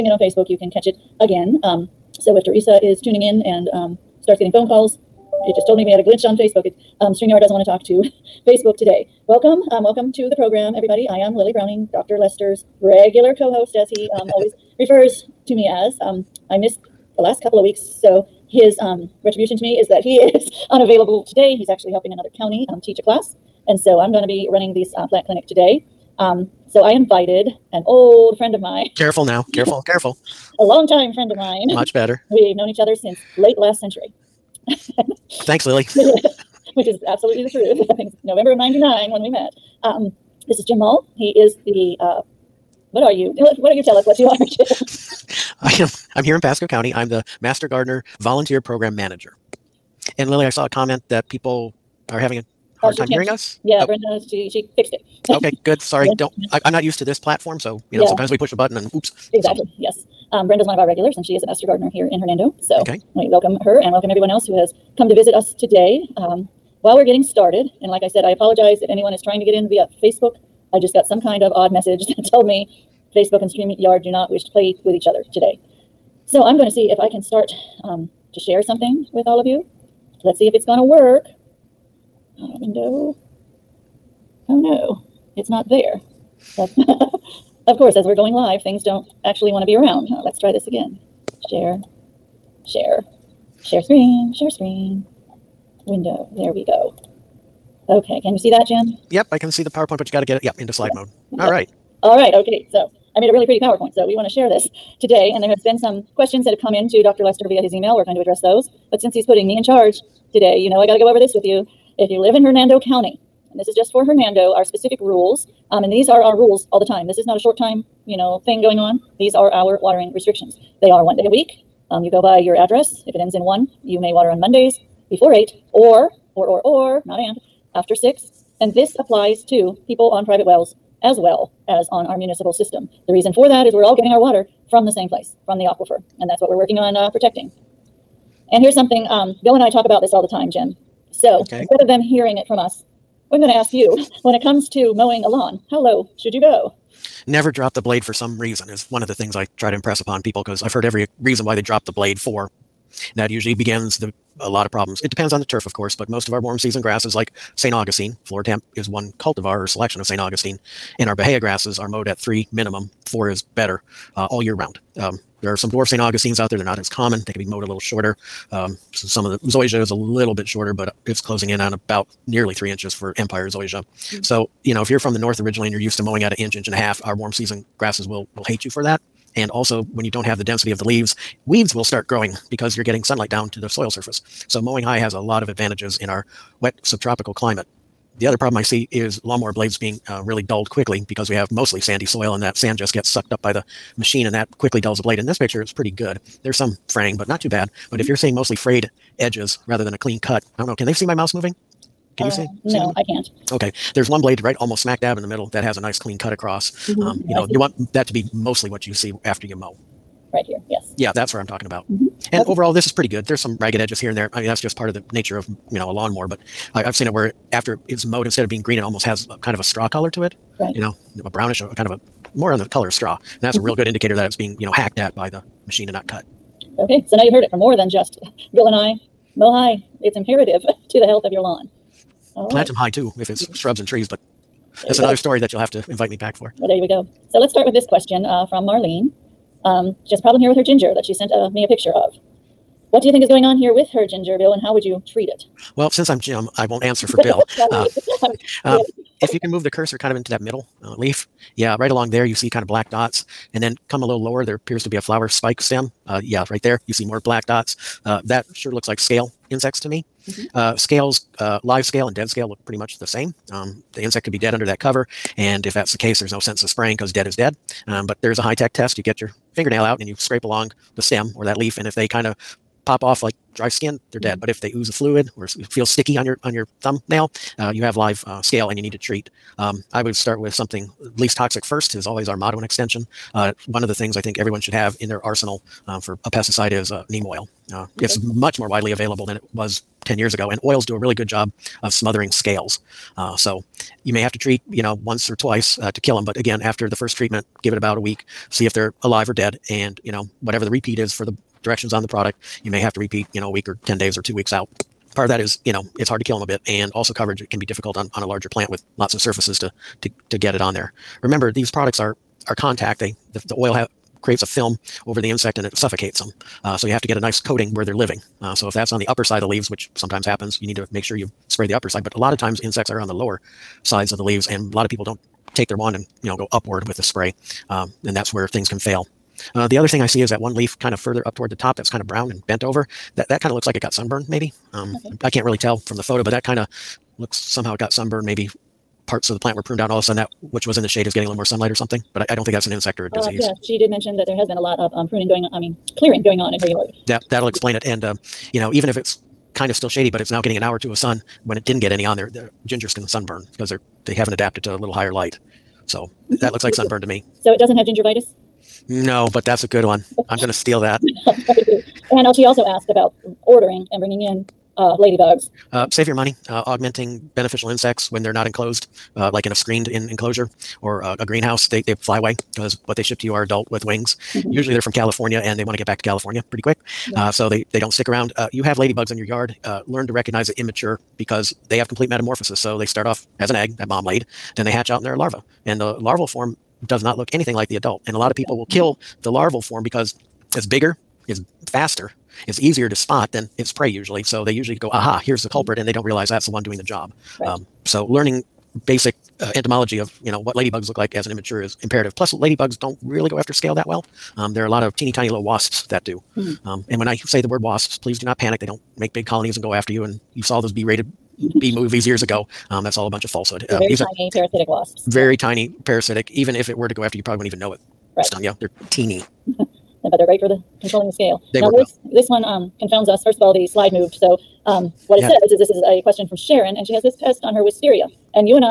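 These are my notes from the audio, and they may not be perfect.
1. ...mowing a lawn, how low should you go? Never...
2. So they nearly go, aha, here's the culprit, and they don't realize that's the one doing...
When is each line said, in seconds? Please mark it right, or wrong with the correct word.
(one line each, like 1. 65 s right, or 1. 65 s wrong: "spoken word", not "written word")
1. 144 s right
2. 394 s wrong: "usually", not "nearly".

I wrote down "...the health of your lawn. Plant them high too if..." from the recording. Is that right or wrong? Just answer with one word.
right.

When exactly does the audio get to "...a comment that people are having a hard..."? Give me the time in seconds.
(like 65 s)
50 s.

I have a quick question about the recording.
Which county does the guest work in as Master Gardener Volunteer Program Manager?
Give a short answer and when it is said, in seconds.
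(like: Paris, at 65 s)
Pasco County, at 46 s.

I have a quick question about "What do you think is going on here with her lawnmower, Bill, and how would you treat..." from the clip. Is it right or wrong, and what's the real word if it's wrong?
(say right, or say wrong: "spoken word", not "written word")
wrong: "ginger", not "lawnmower".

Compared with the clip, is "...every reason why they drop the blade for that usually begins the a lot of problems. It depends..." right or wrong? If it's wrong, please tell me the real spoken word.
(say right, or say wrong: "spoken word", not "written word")
right.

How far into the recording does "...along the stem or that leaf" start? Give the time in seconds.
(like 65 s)
270 s.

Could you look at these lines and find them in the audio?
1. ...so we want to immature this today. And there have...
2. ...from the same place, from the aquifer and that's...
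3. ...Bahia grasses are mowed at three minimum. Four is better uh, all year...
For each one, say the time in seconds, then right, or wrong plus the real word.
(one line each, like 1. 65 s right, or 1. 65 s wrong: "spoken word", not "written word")
1. 103 s wrong: "share", not "immature"
2. 134 s right
3. 161 s right.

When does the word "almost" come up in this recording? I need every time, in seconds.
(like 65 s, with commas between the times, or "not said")
204 s, 218 s.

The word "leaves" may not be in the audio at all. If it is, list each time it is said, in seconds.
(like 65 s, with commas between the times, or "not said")
180 s, 319 s, 324 s.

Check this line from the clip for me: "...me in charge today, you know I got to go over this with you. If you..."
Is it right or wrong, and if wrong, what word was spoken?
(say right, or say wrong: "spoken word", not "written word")
right.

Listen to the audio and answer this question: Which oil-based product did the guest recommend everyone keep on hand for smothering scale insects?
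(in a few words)
Neem oil.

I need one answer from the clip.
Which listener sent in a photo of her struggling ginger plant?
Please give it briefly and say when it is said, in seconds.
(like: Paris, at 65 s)
Marlene, at 238 s.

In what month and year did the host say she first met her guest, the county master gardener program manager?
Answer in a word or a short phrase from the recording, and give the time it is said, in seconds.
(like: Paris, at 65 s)
November 1999, at 38 s.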